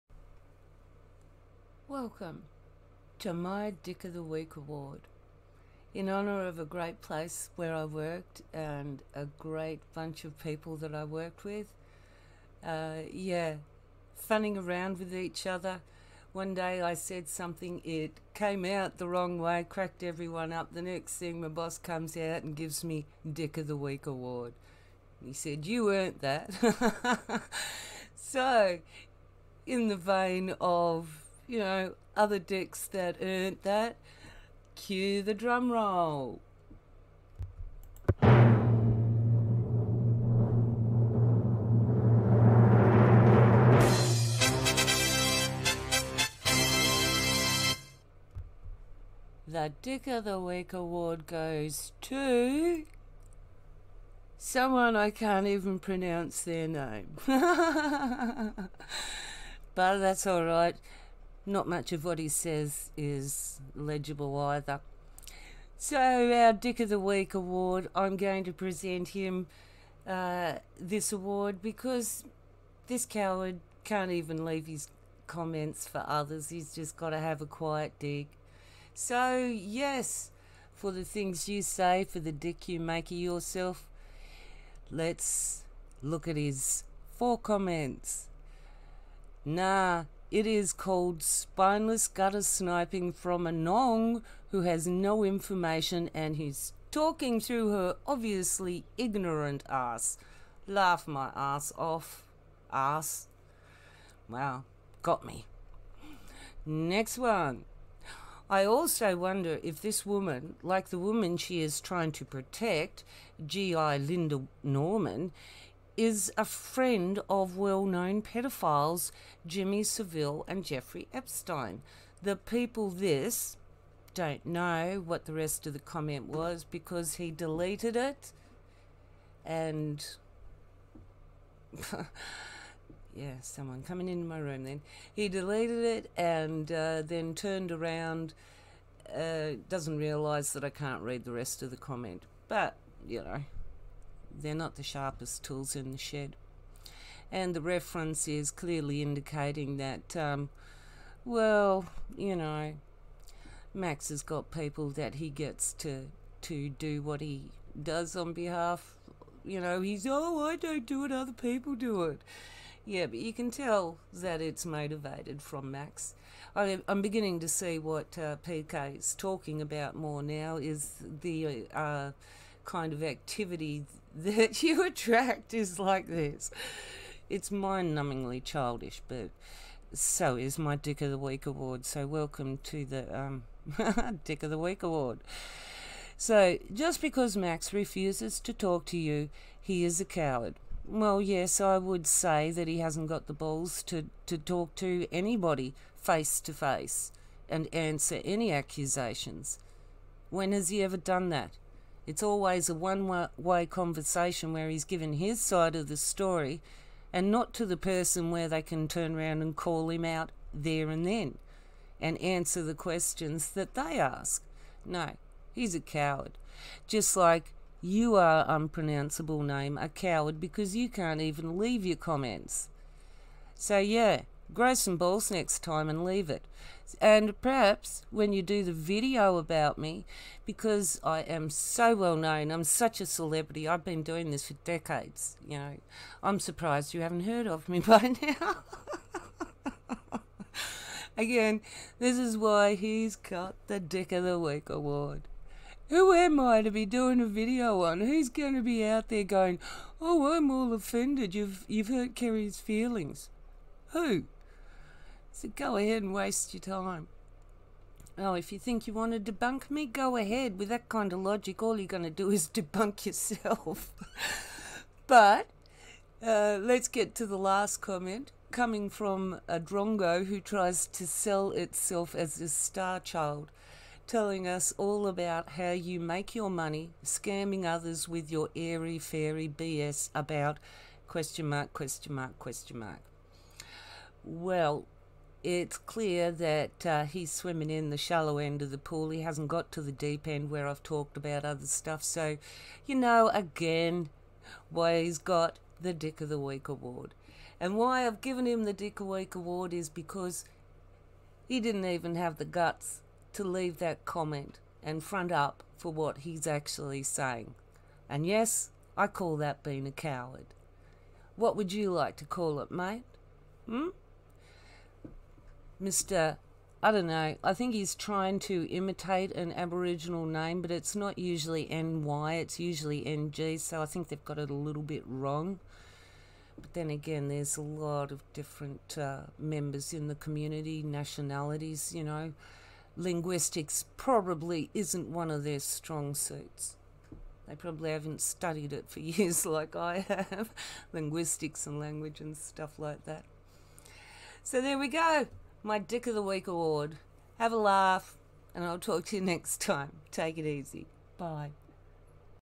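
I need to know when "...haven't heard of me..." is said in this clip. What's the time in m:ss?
3:57.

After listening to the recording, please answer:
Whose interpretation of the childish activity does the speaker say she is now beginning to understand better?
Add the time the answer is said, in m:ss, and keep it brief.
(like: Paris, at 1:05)
PK, at 2:48.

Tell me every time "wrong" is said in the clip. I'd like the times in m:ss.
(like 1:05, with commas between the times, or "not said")
0:19, 5:25.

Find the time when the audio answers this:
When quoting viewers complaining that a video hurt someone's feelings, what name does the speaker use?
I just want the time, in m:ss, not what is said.
4:12.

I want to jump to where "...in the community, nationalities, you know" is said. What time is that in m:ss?
5:29.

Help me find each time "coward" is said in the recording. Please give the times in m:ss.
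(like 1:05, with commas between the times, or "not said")
1:13, 3:10, 3:35, 3:39, 5:09.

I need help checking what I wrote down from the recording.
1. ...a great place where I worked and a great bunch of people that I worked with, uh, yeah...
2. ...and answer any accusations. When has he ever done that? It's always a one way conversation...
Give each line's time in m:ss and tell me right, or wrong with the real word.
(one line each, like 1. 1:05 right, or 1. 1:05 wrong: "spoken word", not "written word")
1. 0:06 right
2. 3:17 right.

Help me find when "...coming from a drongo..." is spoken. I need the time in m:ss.
4:28.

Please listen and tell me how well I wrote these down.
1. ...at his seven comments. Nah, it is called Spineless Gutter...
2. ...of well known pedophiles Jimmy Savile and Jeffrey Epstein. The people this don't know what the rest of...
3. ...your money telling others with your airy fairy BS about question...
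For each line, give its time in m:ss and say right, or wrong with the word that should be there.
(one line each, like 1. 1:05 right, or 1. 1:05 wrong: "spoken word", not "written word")
1. 1:26 wrong: "four", not "seven"
2. 1:57 right
3. 4:36 wrong: "scamming", not "telling".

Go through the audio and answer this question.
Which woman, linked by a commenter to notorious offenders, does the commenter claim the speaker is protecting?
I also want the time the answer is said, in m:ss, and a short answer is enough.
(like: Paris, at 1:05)
Linda Norman, at 1:53.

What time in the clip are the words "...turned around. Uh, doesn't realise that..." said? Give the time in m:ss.
2:17.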